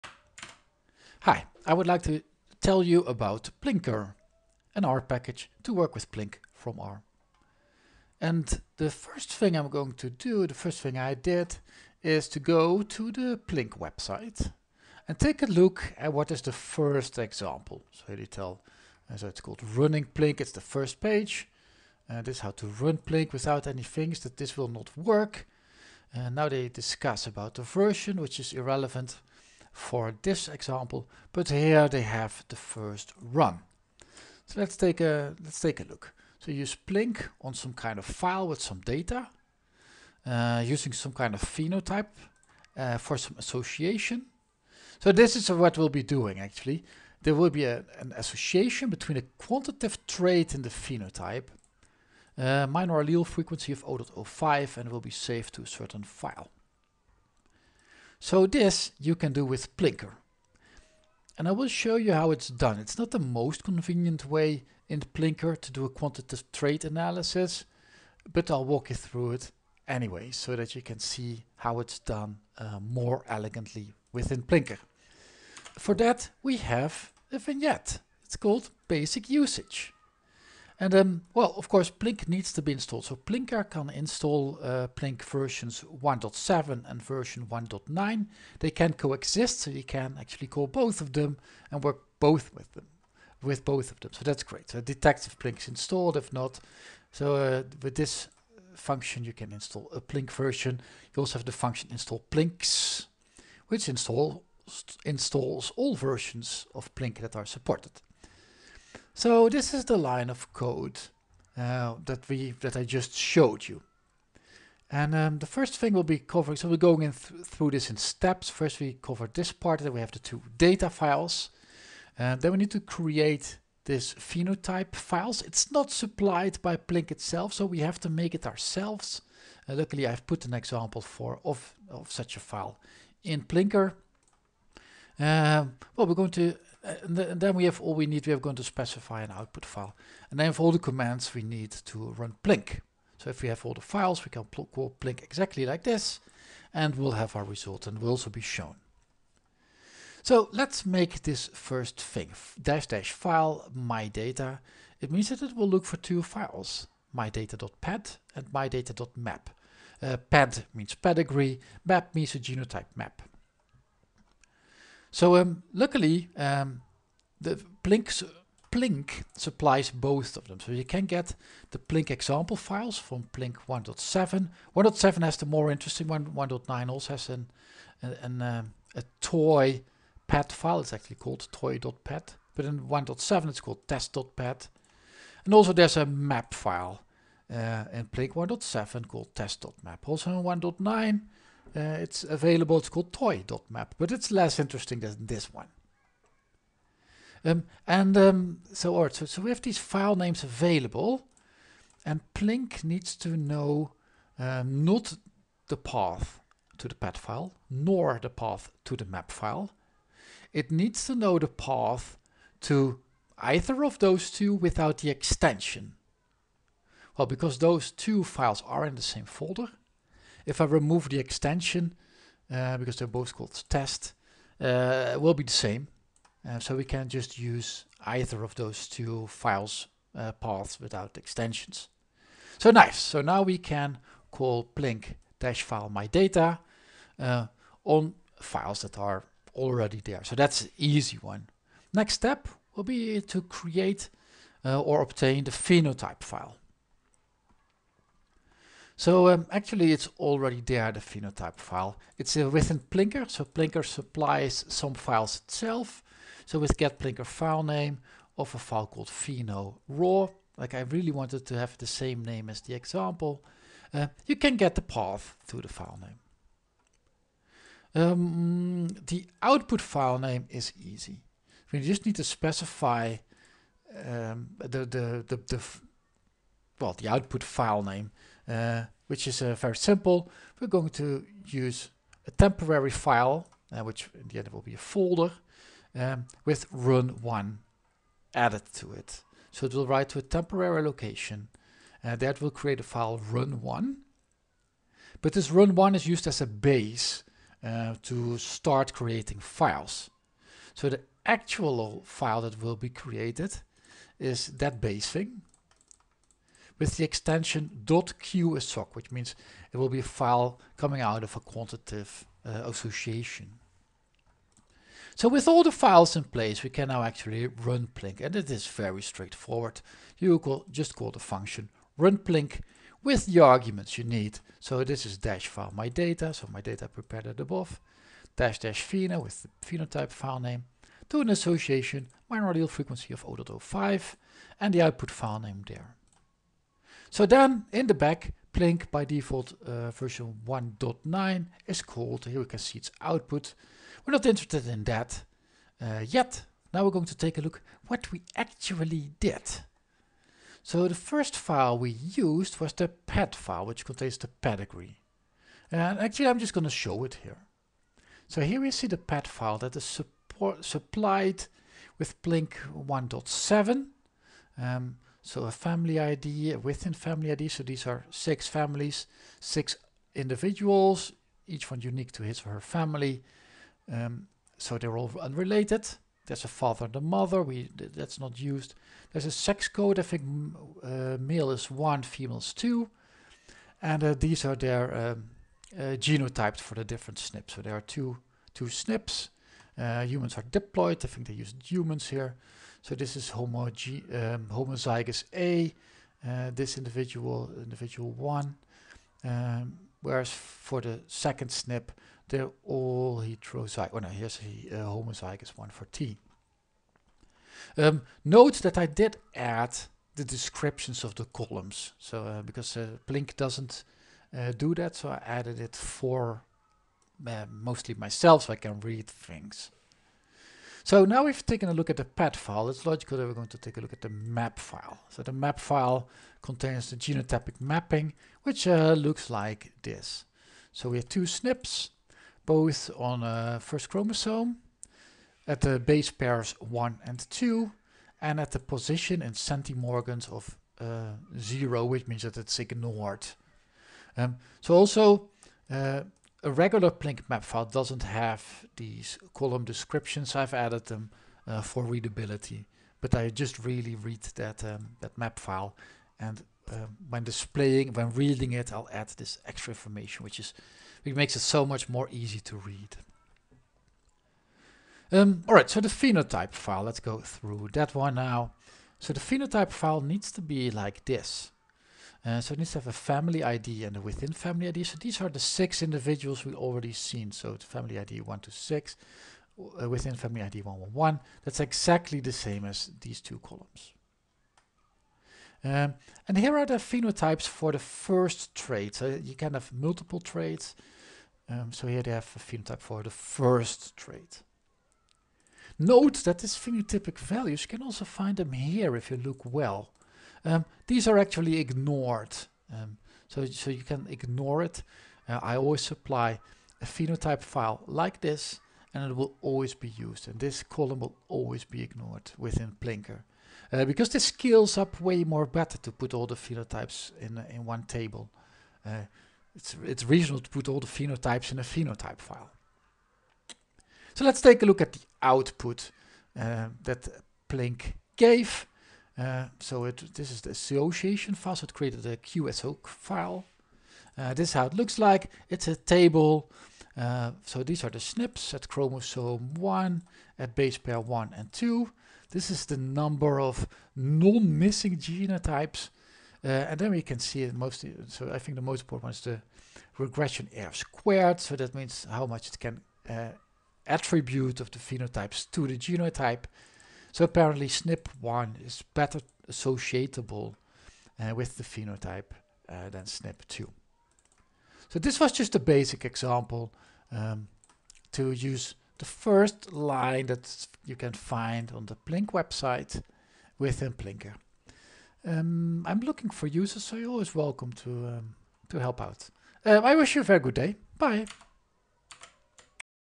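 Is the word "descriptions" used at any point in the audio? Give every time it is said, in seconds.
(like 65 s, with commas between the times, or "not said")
410 s, 449 s.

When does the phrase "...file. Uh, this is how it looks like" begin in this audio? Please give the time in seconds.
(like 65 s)
532 s.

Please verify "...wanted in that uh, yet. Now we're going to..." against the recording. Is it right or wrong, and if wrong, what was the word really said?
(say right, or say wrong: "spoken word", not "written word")
wrong: "interested", not "wanted".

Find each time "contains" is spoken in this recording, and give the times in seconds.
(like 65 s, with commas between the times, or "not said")
353 s, 426 s.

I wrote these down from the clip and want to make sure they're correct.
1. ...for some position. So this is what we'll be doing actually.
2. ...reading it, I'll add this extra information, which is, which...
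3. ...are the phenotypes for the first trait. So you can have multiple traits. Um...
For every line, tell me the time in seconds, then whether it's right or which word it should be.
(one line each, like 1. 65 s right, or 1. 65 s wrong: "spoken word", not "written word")
1. 42 s wrong: "association", not "position"
2. 458 s right
3. 486 s right.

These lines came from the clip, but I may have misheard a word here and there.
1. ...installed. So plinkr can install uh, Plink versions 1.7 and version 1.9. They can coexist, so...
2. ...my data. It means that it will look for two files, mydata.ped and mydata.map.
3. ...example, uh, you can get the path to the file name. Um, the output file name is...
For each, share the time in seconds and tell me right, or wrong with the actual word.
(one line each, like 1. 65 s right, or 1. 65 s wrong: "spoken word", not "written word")
1. 82 s right
2. 153 s right
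3. 262 s right.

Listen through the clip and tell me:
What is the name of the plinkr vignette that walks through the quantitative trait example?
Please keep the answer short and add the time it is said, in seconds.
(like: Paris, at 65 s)
basic usage, at 78 s.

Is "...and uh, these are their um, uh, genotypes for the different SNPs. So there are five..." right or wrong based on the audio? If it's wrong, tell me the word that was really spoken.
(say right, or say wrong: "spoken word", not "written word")
wrong: "two", not "five".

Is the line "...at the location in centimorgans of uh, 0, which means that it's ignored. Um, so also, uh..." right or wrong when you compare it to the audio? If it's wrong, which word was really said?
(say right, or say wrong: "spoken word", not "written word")
wrong: "position", not "location".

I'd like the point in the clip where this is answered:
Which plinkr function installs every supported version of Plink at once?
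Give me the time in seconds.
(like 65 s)
101 s.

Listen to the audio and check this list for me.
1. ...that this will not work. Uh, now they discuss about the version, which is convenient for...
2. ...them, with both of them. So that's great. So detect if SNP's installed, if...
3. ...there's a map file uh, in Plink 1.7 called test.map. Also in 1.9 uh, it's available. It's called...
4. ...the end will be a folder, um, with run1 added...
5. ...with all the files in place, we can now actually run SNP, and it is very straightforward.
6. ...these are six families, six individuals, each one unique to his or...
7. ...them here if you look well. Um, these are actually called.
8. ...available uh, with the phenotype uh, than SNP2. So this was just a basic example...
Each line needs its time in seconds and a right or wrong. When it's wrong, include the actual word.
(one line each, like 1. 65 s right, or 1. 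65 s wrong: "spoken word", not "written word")
1. 24 s wrong: "irrelevant", not "convenient"
2. 92 s wrong: "Plink", not "SNP"
3. 185 s right
4. 284 s right
5. 315 s wrong: "Plink", not "SNP"
6. 367 s right
7. 498 s wrong: "ignored", not "called"
8. 559 s wrong: "associatable", not "available".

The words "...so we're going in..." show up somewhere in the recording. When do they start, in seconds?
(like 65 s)
116 s.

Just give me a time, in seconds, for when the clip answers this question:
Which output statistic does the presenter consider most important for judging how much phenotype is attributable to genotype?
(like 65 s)
549 s.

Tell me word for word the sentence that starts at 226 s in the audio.
Uh, so we can just use either of those two files uh, paths without extensions.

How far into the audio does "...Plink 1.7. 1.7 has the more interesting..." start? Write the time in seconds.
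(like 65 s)
173 s.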